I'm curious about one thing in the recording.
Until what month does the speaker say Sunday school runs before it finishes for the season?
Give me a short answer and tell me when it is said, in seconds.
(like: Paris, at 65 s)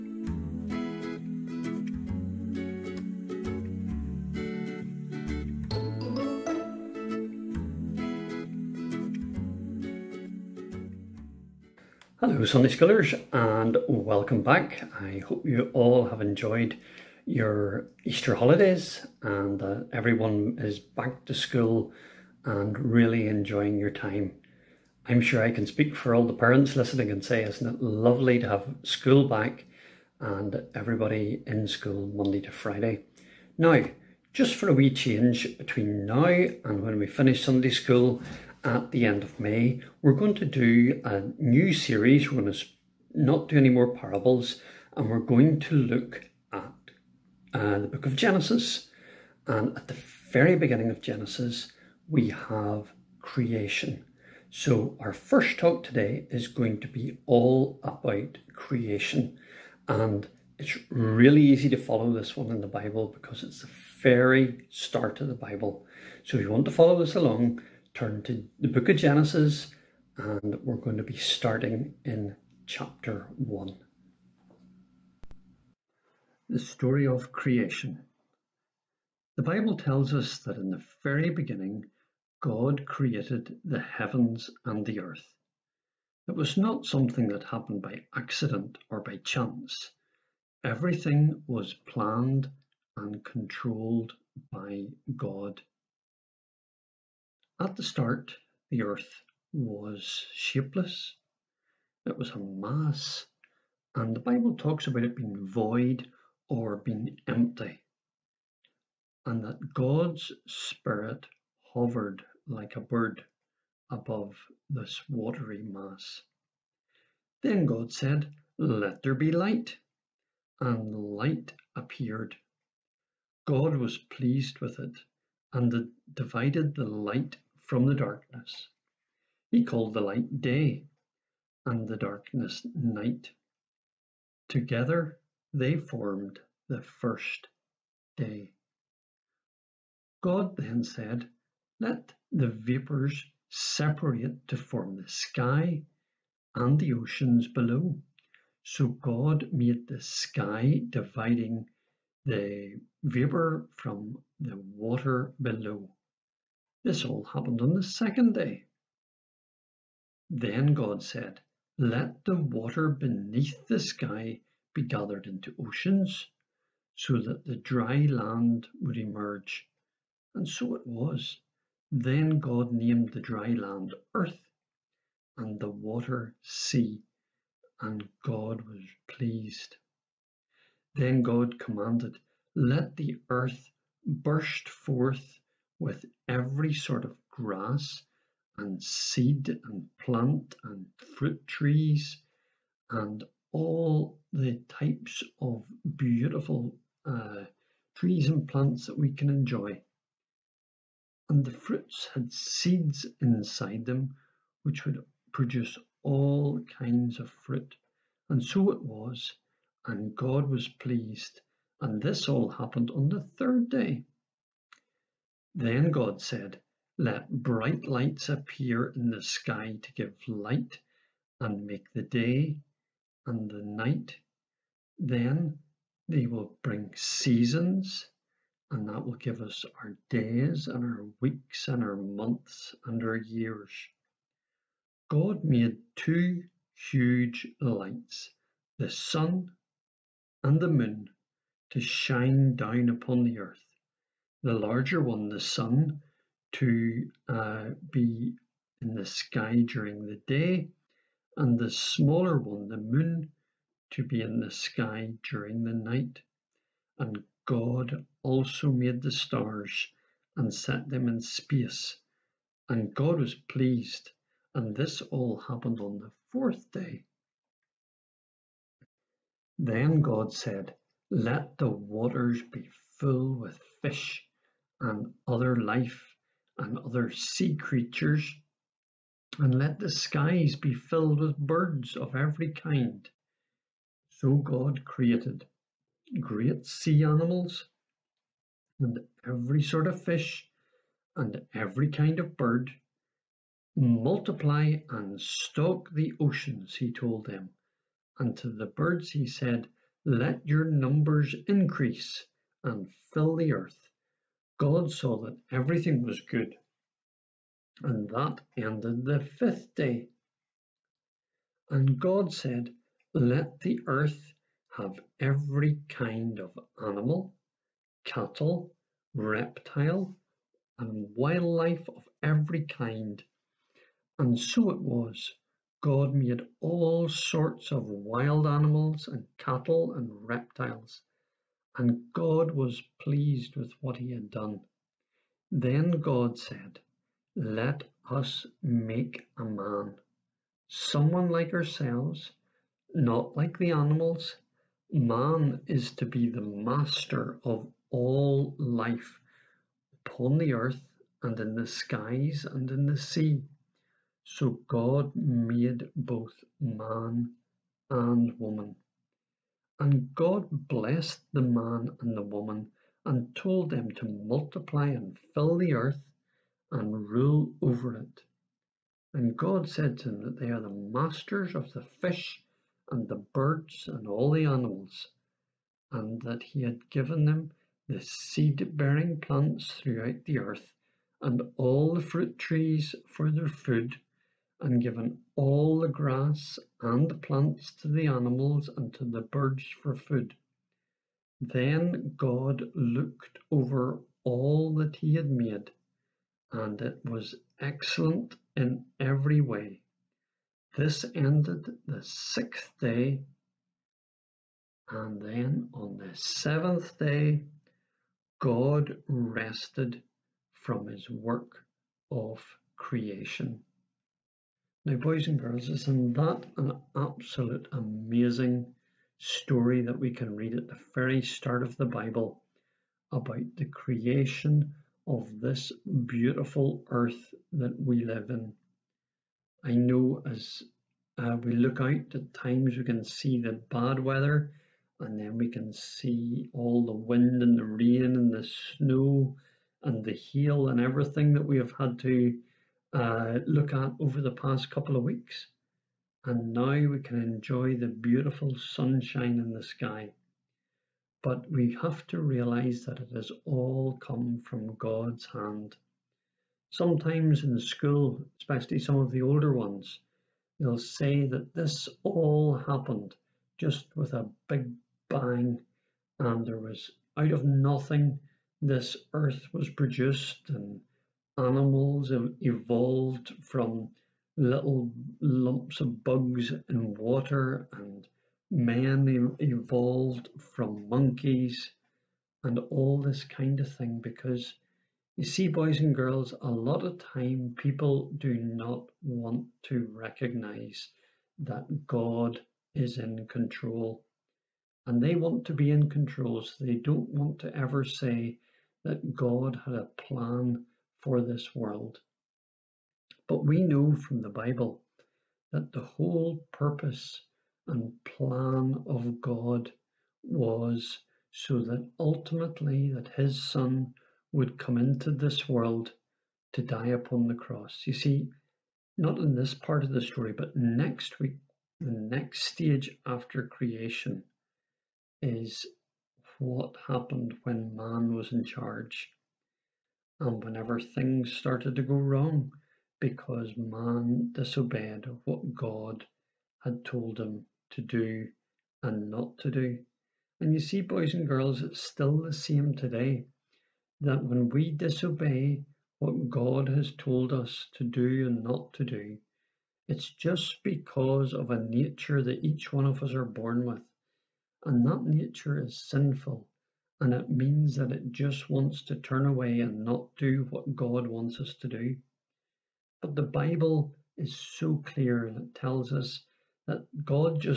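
May, at 39 s.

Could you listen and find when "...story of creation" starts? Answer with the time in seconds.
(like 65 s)
76 s.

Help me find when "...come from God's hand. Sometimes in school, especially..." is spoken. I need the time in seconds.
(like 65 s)
453 s.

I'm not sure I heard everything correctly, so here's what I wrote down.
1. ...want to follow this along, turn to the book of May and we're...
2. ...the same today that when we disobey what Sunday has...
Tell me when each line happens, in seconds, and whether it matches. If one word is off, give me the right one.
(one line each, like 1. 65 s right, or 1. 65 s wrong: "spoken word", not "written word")
1. 66 s wrong: "Genesis", not "May"
2. 542 s wrong: "God", not "Sunday".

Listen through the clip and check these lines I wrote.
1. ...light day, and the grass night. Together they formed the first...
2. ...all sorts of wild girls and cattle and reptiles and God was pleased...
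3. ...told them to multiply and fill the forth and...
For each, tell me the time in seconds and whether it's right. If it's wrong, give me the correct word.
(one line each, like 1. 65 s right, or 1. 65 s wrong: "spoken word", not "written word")
1. 130 s wrong: "darkness", not "grass"
2. 326 s wrong: "animals", not "girls"
3. 363 s wrong: "earth", not "forth".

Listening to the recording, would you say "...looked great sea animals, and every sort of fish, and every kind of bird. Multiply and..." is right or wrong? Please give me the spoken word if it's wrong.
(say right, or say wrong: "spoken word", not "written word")
wrong: "created", not "looked".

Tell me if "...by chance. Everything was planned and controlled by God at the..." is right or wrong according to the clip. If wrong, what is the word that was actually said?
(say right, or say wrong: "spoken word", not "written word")
right.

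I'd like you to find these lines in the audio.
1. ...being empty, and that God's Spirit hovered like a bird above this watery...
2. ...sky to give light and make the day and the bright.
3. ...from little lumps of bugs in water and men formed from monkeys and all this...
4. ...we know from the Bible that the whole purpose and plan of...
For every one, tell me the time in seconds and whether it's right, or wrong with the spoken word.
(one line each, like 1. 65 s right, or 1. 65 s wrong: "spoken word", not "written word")
1. 106 s right
2. 219 s wrong: "night", not "bright"
3. 473 s wrong: "evolved", not "formed"
4. 503 s right.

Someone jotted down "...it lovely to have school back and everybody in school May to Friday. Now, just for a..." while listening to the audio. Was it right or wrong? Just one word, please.
wrong.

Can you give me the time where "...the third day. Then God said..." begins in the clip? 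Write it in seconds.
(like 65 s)
213 s.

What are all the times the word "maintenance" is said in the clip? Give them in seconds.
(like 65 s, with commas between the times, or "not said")
not said.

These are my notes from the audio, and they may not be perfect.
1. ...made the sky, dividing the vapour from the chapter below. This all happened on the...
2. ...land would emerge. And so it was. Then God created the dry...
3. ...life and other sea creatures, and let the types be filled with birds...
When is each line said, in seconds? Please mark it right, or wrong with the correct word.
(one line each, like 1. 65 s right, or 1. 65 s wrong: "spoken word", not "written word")
1. 149 s wrong: "water", not "chapter"
2. 168 s wrong: "named", not "created"
3. 275 s wrong: "skies", not "types".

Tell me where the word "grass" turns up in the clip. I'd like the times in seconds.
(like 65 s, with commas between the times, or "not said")
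187 s, 385 s.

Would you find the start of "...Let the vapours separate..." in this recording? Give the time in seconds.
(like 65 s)
141 s.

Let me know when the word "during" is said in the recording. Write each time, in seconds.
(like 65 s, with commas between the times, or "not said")
249 s, 255 s.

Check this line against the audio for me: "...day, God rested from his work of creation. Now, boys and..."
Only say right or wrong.
right.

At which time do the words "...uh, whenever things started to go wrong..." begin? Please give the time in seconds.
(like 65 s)
530 s.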